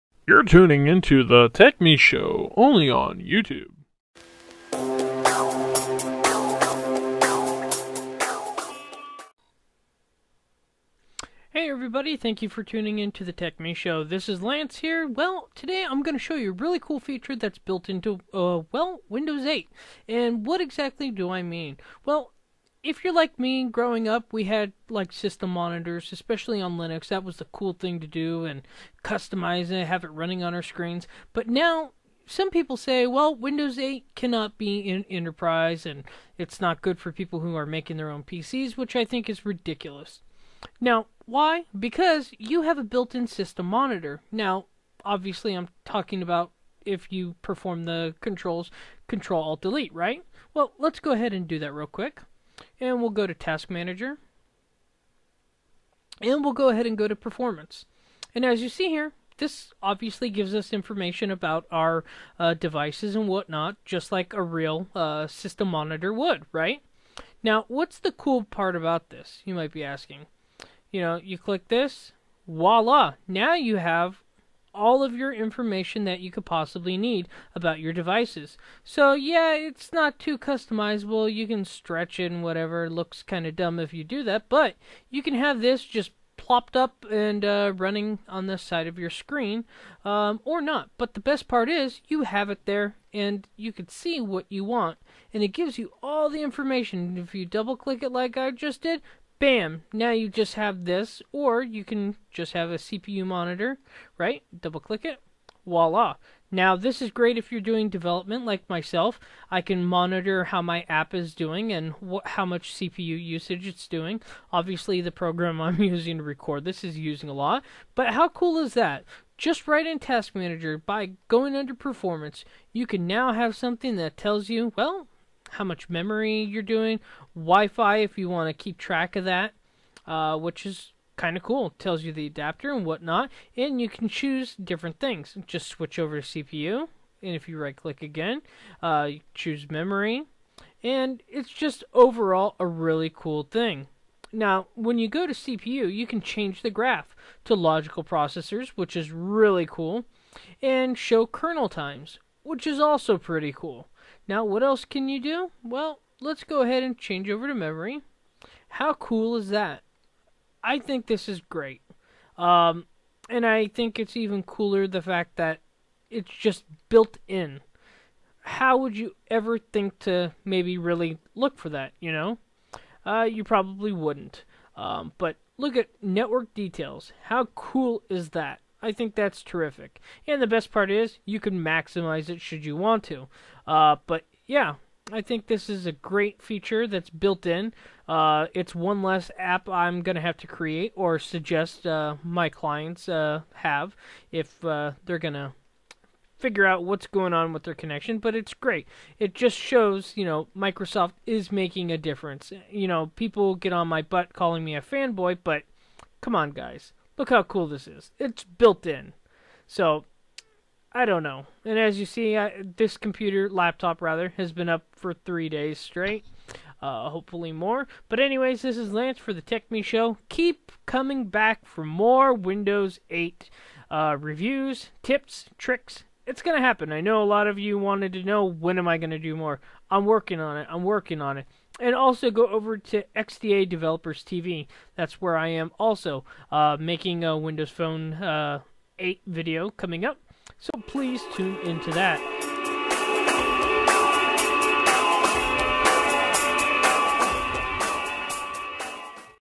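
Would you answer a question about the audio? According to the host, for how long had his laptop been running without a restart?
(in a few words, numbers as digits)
3 days.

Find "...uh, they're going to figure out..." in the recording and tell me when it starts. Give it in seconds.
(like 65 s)
194 s.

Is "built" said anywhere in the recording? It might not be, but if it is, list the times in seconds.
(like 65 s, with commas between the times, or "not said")
17 s, 42 s, 166 s, 187 s, 208 s.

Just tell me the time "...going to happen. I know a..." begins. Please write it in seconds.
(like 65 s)
226 s.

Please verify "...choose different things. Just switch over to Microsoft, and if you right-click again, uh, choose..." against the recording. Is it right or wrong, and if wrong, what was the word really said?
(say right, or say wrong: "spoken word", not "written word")
wrong: "CPU", not "Microsoft".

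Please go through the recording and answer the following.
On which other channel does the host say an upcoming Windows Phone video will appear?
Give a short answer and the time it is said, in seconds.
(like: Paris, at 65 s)
XDA Developers TV, at 233 s.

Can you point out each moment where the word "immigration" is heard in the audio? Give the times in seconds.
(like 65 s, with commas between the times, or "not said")
not said.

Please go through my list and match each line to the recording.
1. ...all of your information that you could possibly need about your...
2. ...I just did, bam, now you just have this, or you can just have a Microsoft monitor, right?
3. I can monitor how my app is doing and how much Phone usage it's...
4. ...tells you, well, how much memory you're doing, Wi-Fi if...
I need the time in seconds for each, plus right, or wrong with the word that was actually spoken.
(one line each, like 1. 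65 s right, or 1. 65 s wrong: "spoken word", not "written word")
1. 74 s right
2. 98 s wrong: "CPU", not "Microsoft"
3. 109 s wrong: "CPU", not "Phone"
4. 124 s right.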